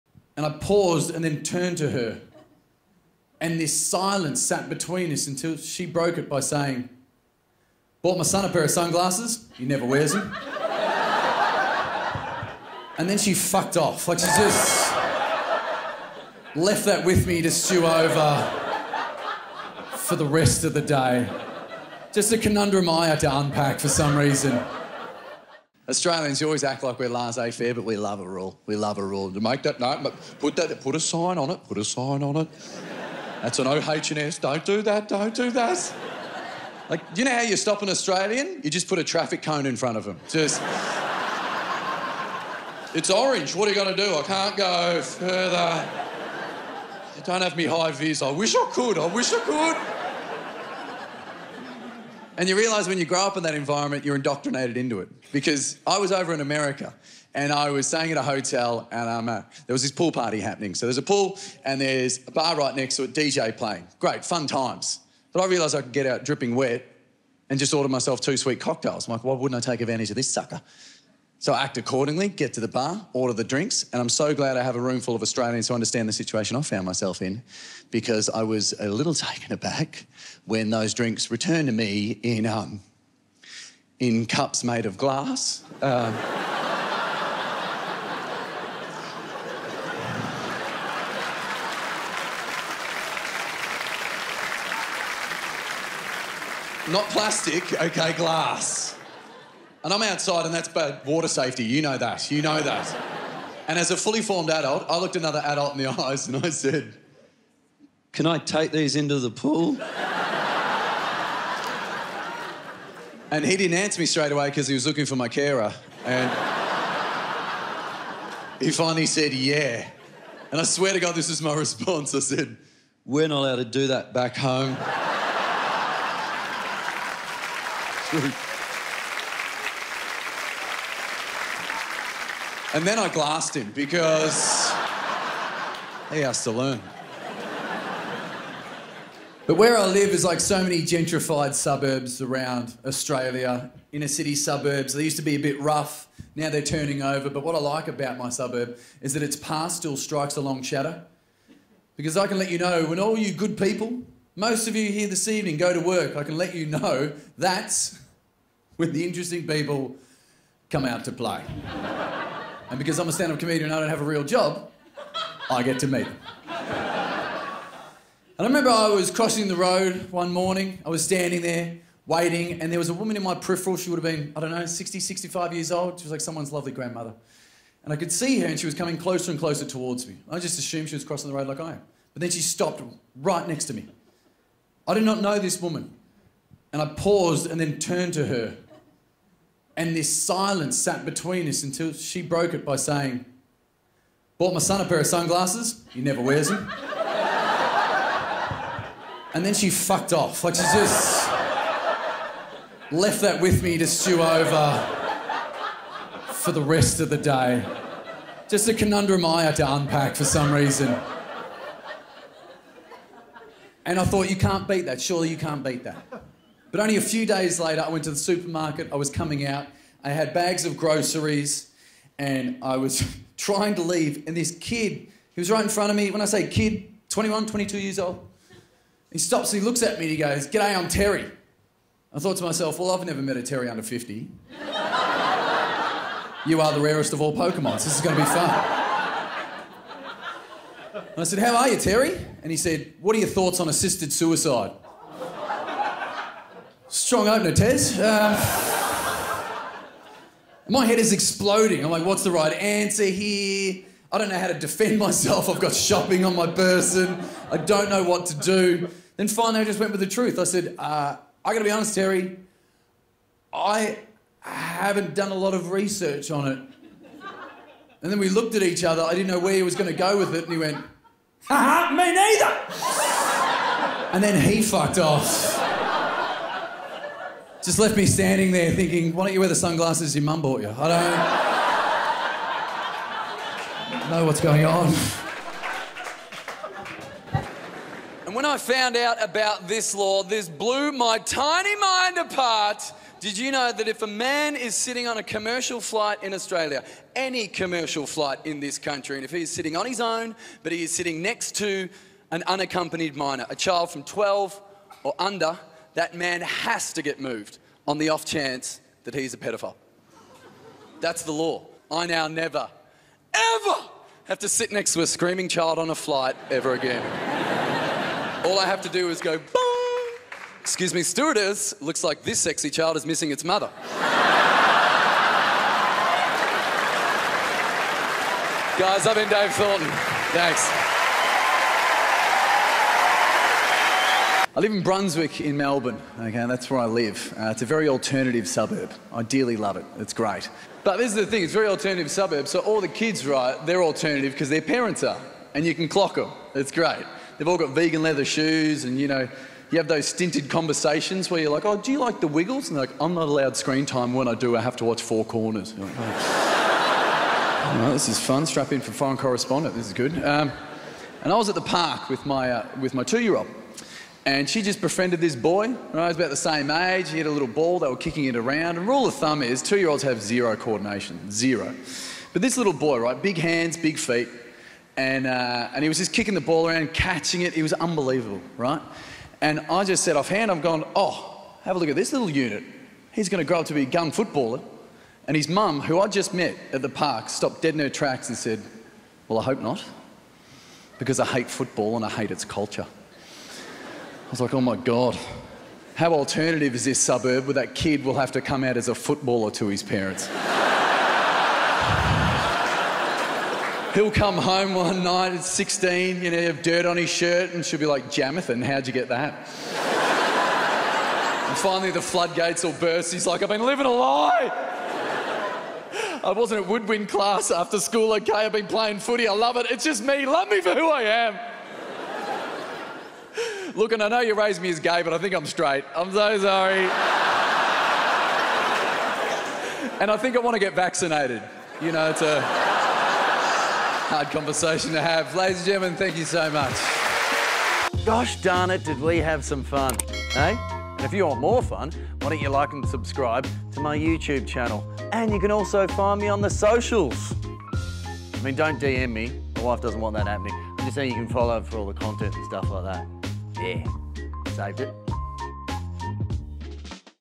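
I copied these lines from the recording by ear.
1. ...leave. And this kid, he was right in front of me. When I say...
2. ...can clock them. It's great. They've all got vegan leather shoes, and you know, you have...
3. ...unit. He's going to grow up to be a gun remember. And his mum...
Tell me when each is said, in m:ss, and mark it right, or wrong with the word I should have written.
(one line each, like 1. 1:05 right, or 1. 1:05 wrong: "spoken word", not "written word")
1. 3:43 right
2. 5:45 right
3. 6:22 wrong: "footballer", not "remember".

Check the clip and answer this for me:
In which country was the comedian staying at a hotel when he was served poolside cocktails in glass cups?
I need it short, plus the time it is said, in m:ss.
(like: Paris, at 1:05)
America, at 0:56.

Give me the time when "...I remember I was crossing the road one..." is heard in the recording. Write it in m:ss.
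2:48.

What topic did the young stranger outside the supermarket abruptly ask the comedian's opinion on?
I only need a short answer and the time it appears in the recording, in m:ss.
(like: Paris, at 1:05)
assisted suicide, at 4:03.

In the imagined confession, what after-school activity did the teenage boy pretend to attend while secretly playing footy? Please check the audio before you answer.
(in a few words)
woodwind class.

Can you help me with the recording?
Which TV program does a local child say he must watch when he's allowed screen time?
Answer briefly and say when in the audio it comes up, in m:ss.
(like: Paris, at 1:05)
Four Corners, at 5:55.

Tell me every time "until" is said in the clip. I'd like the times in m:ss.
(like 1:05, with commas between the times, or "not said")
0:05, 3:11.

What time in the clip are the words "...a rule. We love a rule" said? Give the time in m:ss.
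0:28.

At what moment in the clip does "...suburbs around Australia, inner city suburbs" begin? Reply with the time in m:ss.
2:21.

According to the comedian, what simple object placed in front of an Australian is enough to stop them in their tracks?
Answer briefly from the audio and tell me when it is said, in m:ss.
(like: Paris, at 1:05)
traffic cone, at 0:39.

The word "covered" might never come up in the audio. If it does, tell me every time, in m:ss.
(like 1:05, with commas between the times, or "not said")
not said.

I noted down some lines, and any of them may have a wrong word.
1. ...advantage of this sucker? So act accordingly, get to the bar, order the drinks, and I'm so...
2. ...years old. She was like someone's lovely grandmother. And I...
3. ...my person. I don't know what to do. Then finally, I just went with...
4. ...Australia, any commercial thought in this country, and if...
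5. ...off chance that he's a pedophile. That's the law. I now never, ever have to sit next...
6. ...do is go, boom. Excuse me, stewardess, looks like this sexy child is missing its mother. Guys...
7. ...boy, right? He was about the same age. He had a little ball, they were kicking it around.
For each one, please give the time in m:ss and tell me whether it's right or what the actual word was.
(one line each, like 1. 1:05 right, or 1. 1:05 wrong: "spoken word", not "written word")
1. 1:09 right
2. 2:55 right
3. 4:16 right
4. 4:56 wrong: "flight", not "thought"
5. 5:08 right
6. 5:18 right
7. 6:05 right.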